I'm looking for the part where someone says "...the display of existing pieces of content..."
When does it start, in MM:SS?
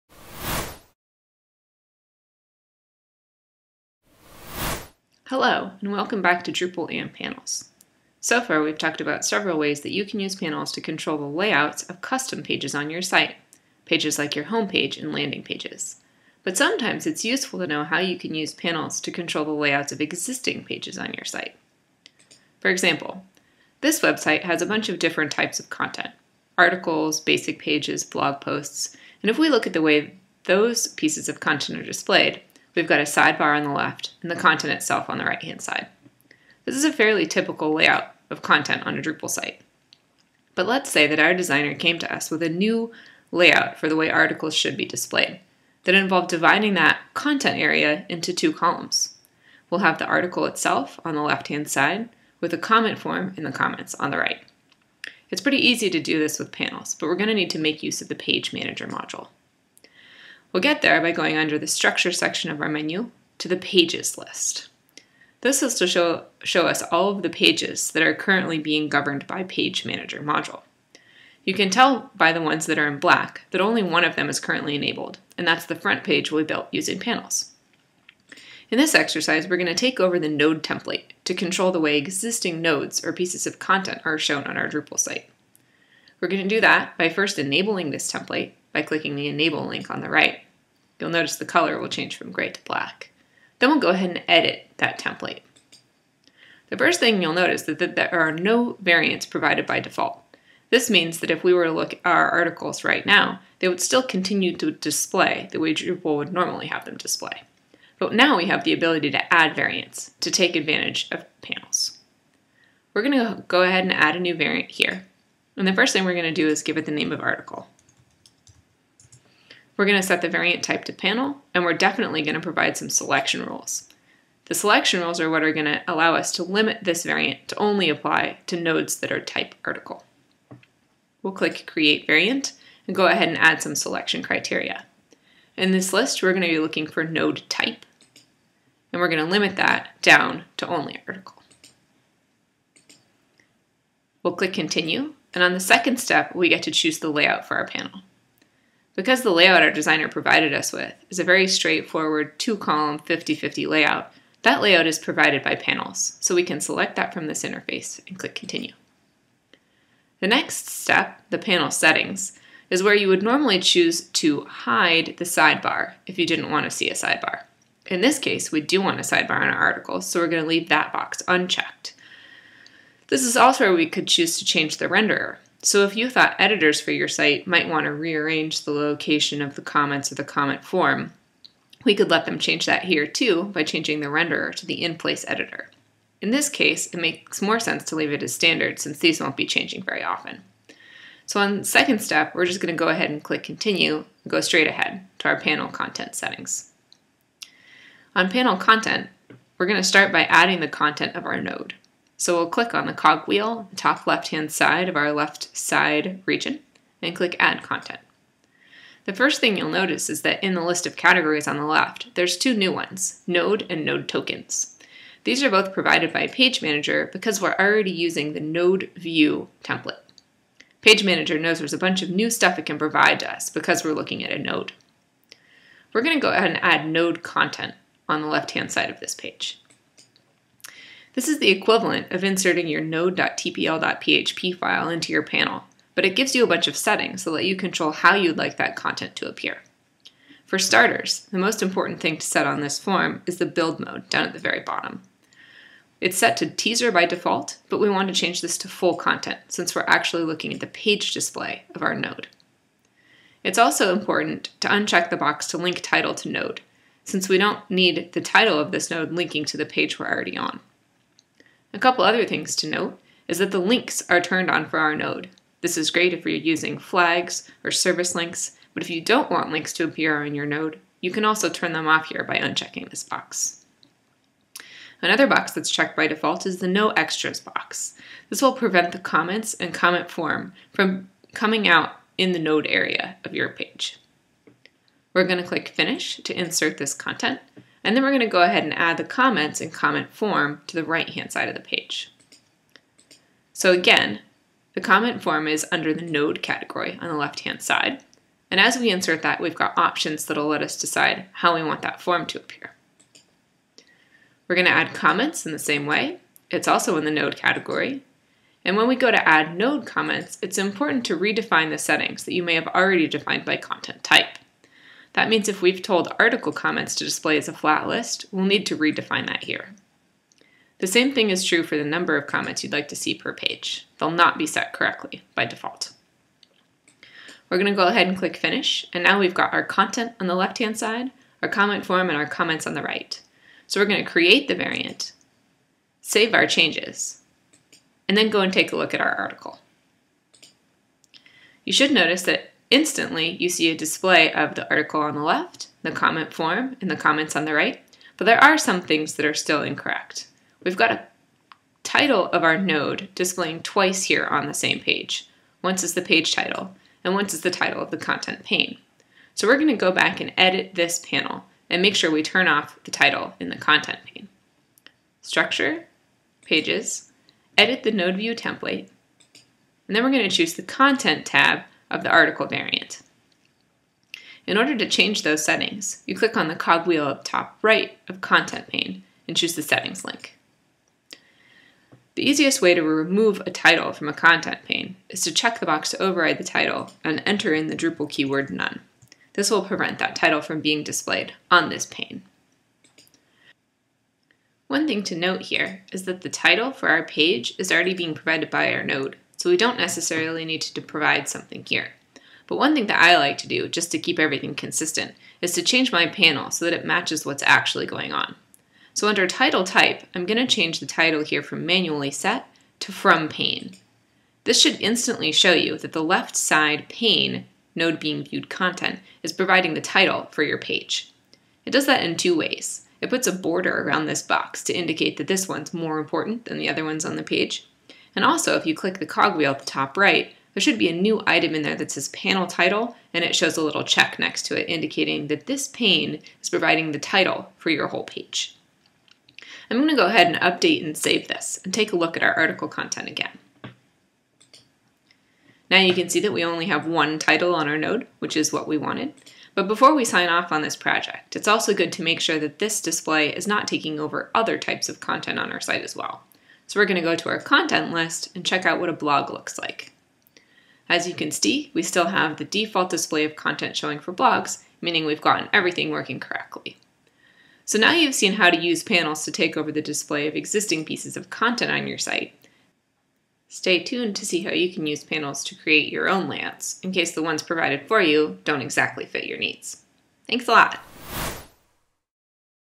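07:49.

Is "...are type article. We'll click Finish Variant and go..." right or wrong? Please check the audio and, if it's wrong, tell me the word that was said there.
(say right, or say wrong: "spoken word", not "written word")
wrong: "Create", not "Finish".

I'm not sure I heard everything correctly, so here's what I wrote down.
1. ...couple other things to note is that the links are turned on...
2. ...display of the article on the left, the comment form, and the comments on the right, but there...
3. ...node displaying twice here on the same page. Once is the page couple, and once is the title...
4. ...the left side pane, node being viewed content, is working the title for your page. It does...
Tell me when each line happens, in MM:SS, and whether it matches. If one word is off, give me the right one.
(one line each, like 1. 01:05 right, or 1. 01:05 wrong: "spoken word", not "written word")
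1. 04:21 right
2. 05:43 right
3. 05:52 wrong: "title", not "couple"
4. 06:55 wrong: "providing", not "working".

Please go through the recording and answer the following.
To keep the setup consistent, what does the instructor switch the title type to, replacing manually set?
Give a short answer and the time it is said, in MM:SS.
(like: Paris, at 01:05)
from pane, at 06:52.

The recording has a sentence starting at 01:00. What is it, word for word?
We'll get there by going under the structure section of our menu to the pages list.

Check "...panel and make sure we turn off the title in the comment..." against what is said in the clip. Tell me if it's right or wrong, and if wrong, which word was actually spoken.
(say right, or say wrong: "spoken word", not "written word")
wrong: "content", not "comment".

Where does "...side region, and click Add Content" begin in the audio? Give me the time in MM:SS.
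03:25.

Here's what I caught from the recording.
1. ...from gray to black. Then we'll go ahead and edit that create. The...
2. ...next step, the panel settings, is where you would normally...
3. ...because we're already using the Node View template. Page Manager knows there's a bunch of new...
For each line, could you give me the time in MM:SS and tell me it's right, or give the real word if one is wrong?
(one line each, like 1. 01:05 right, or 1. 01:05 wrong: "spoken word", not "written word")
1. 01:32 wrong: "template", not "create"
2. 02:40 right
3. 03:37 right.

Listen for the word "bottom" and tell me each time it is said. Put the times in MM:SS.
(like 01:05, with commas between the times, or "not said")
04:04.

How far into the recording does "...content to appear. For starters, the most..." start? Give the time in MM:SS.
03:58.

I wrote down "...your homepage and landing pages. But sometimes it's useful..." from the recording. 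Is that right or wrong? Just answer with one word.
right.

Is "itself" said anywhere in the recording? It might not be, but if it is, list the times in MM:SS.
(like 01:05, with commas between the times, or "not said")
00:34, 00:50.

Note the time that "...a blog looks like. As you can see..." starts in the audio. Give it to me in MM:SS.
07:38.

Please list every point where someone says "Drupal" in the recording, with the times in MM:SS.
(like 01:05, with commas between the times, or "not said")
00:06, 00:39, 01:24, 01:45, 06:27.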